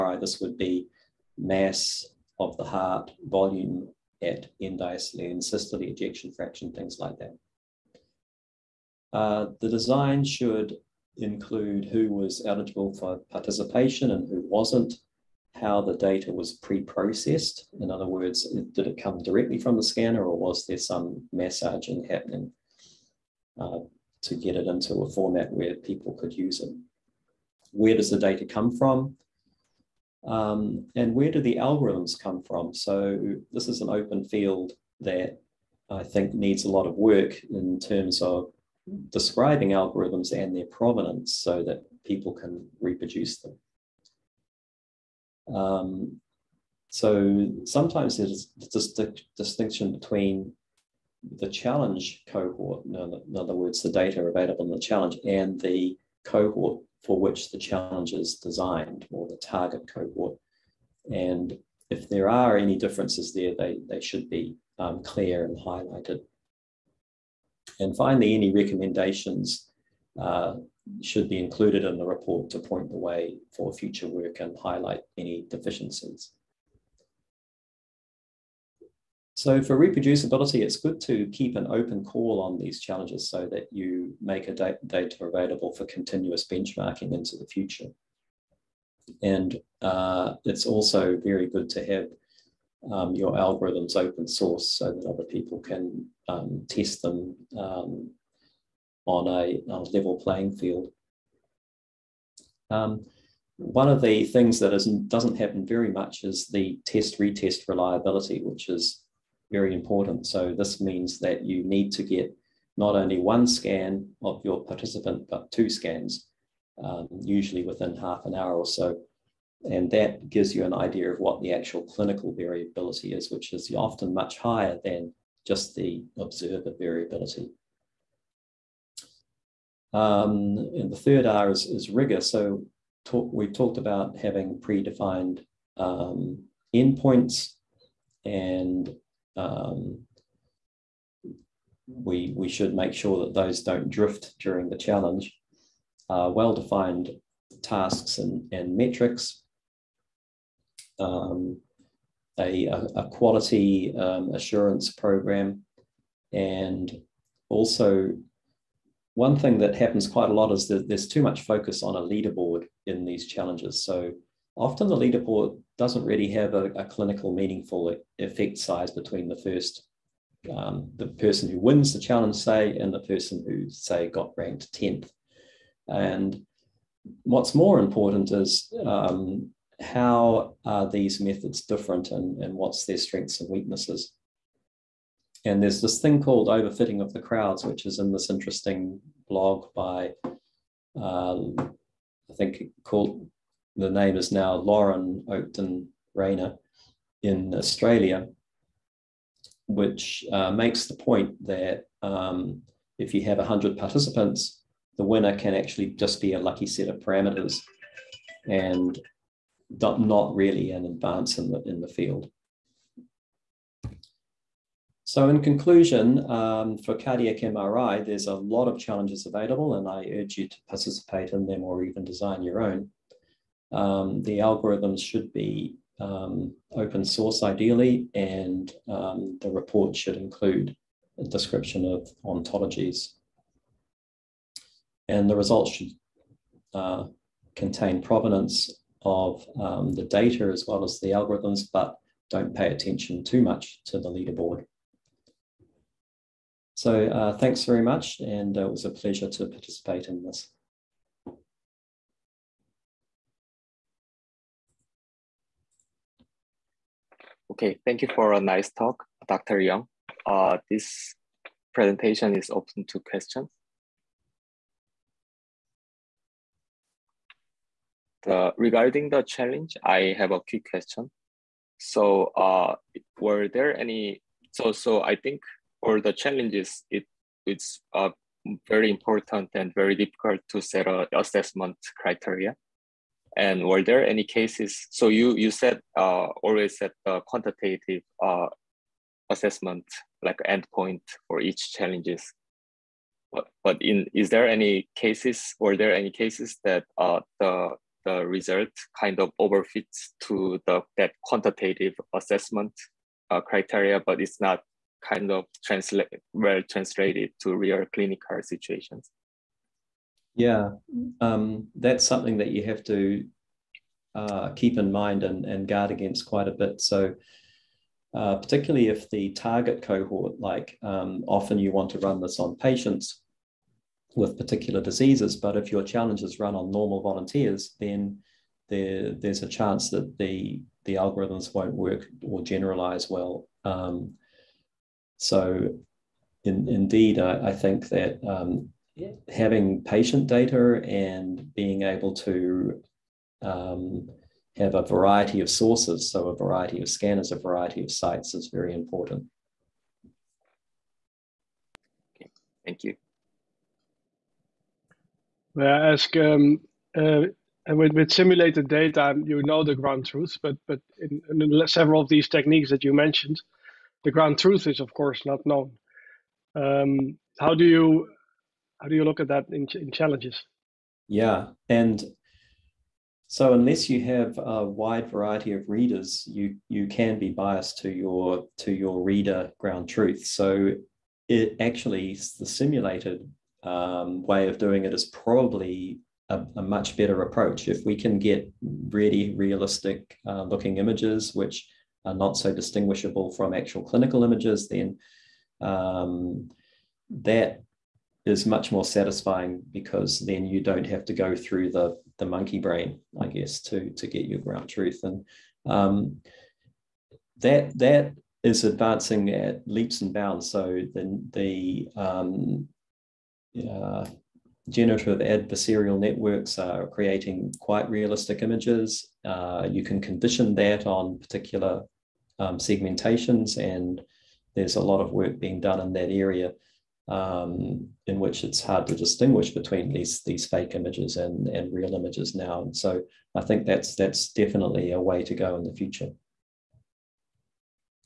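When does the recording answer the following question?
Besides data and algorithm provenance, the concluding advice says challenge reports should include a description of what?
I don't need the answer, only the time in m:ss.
3:52.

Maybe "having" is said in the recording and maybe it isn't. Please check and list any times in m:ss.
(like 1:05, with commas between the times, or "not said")
2:14, 5:39.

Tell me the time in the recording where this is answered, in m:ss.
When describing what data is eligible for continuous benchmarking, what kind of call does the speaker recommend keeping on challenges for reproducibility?
1:21.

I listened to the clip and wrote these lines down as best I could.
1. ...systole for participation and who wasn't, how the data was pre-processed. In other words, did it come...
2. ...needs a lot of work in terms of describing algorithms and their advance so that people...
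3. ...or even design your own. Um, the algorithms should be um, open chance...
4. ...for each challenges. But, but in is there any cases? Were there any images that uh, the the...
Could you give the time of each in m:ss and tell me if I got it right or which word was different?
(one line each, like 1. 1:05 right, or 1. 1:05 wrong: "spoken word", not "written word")
1. 0:12 wrong: "eligible", not "systole"
2. 0:36 wrong: "provenance", not "advance"
3. 3:41 wrong: "source", not "chance"
4. 4:51 wrong: "cases", not "images".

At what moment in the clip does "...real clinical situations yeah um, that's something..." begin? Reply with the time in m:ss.
5:07.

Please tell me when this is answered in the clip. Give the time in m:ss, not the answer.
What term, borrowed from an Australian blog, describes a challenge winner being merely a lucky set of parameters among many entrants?
3:06.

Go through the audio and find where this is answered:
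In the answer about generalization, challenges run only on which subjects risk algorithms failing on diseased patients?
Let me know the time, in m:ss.
5:26.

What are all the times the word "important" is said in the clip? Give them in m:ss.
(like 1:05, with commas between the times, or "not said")
1:49, 2:57, 4:38, 5:48.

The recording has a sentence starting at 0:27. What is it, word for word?
Where does the data come from?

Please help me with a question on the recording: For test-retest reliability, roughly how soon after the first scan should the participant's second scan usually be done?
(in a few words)
Half an hour.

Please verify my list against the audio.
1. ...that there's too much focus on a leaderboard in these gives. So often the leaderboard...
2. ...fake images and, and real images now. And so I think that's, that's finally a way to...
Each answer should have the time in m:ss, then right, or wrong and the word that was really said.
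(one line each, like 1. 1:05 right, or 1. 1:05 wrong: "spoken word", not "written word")
1. 2:40 wrong: "challenges", not "gives"
2. 7:10 wrong: "definitely", not "finally".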